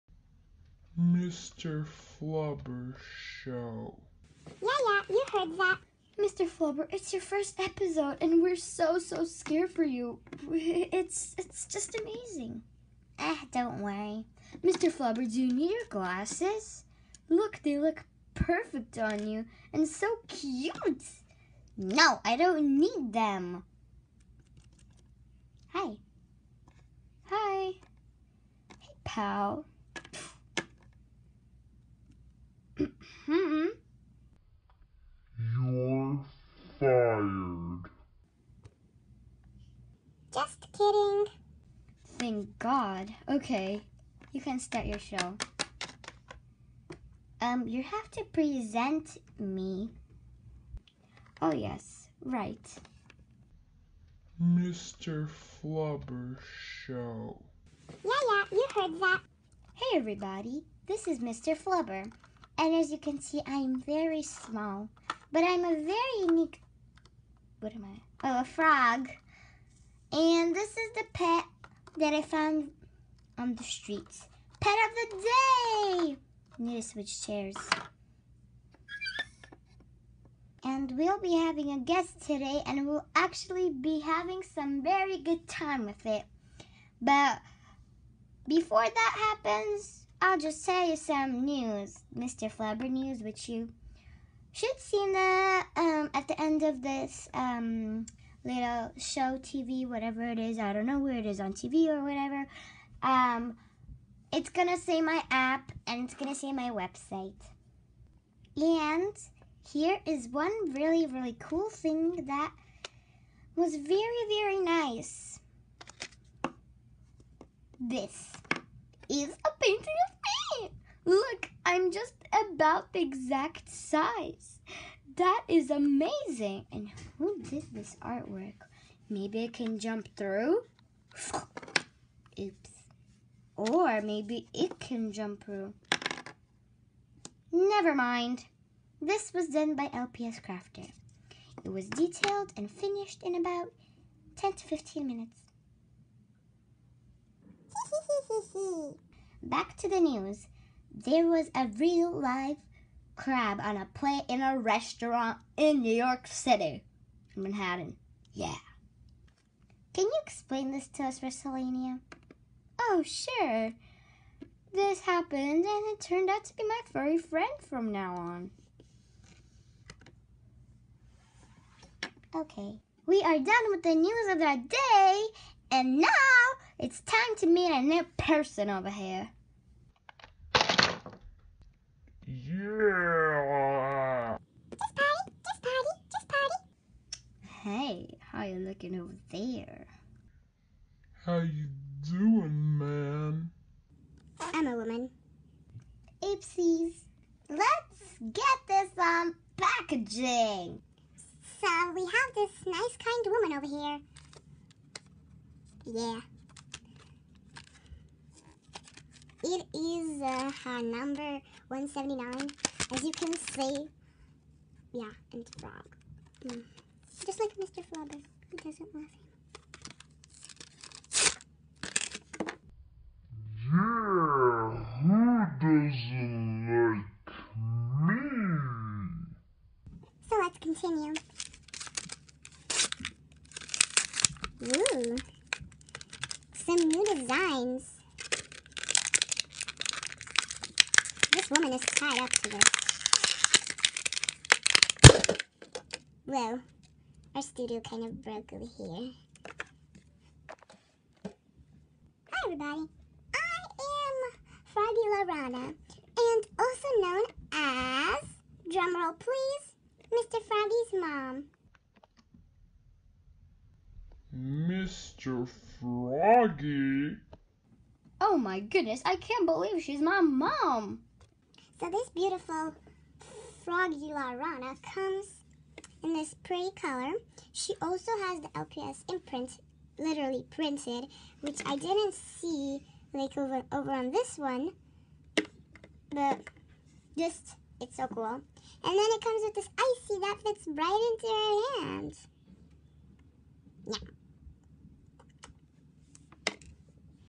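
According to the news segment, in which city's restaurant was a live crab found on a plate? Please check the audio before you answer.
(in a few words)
New York City.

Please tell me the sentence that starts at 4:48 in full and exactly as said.
And then it comes with this icy that fits right into her hands.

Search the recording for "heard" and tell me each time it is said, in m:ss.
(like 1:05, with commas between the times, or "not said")
0:05, 0:58.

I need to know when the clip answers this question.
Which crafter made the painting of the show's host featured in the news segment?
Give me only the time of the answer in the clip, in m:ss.
2:19.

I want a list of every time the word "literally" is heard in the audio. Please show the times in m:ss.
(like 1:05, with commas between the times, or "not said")
4:39.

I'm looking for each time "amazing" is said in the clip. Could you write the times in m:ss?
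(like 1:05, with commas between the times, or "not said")
0:12, 2:05.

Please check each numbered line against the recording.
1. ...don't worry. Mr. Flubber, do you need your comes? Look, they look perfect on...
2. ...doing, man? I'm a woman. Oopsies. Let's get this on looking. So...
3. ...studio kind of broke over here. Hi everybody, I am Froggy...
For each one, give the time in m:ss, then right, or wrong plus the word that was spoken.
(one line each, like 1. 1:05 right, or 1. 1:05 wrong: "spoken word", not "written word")
1. 0:13 wrong: "glasses", not "comes"
2. 3:12 wrong: "packaging", not "looking"
3. 4:07 right.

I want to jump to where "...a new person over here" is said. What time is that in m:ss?
2:57.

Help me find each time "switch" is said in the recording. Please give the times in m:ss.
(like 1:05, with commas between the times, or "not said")
1:16.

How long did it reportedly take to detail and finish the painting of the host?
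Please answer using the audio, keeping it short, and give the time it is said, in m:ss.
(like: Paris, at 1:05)
10 to 15 minutes, at 2:24.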